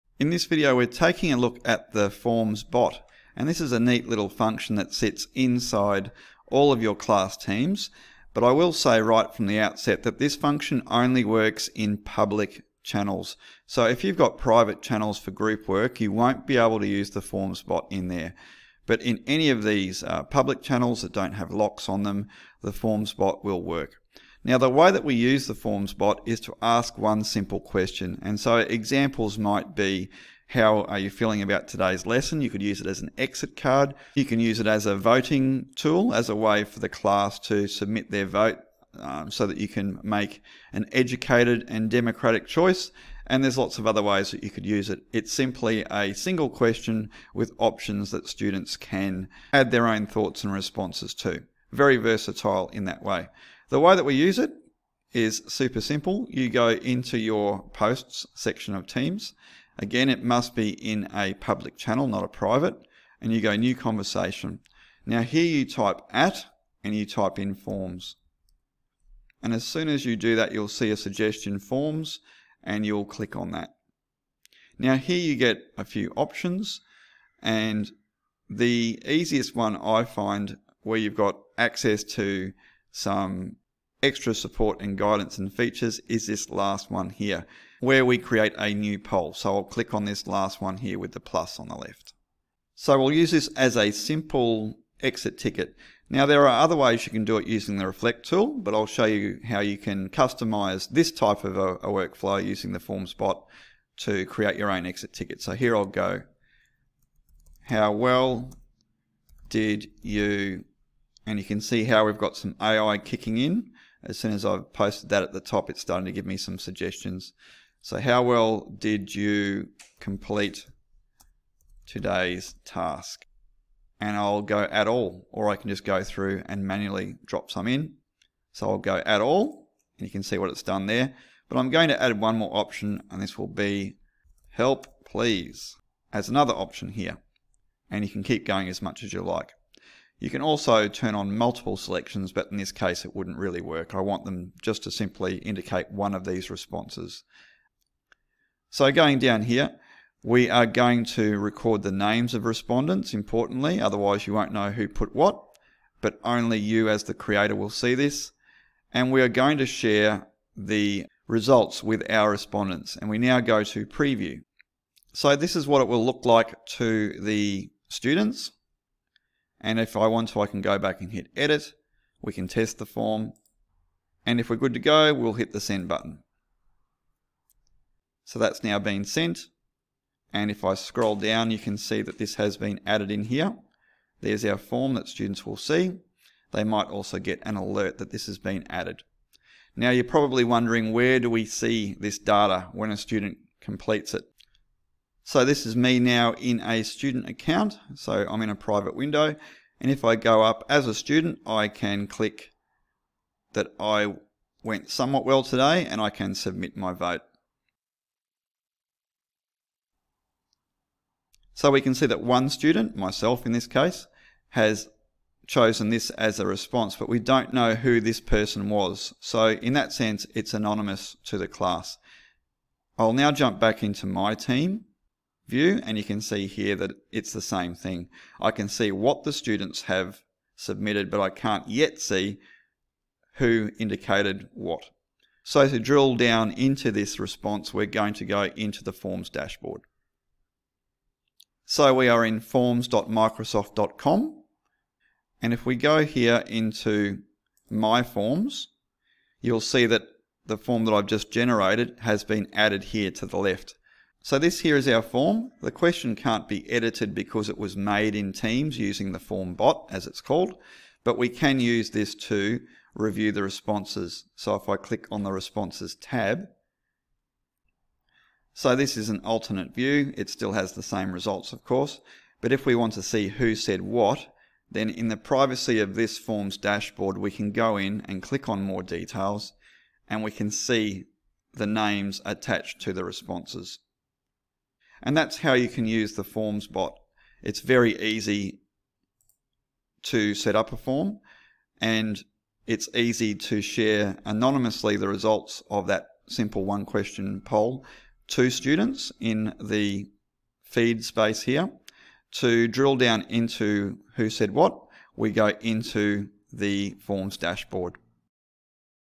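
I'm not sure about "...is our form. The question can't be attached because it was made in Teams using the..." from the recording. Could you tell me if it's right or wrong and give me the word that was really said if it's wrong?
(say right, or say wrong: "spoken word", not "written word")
wrong: "edited", not "attached".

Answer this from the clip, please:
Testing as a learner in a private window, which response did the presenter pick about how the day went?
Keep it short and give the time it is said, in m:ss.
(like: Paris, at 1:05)
Somewhat well, at 3:24.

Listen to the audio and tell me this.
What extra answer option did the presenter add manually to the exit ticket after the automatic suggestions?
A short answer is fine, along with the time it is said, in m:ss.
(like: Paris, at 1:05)
Help please, at 2:14.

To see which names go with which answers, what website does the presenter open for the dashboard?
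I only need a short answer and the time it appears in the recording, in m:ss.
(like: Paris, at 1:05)
forms.microsoft.com, at 4:02.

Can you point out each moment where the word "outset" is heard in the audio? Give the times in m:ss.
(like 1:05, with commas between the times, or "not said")
0:09.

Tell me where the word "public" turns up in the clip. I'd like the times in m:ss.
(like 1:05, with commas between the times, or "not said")
0:11, 0:20, 1:01.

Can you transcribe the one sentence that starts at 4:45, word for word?
And that's how you can use the forms bot.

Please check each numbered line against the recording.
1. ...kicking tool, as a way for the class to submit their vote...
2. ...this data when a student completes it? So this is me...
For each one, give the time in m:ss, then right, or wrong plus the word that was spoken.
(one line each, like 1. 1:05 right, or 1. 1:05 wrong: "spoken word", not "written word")
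1. 0:34 wrong: "voting", not "kicking"
2. 3:11 right.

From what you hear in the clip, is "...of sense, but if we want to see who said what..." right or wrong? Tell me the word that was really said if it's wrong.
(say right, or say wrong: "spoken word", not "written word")
wrong: "course", not "sense".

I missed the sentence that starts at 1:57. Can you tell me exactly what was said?
So how well did you complete today's task?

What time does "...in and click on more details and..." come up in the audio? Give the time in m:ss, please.
4:37.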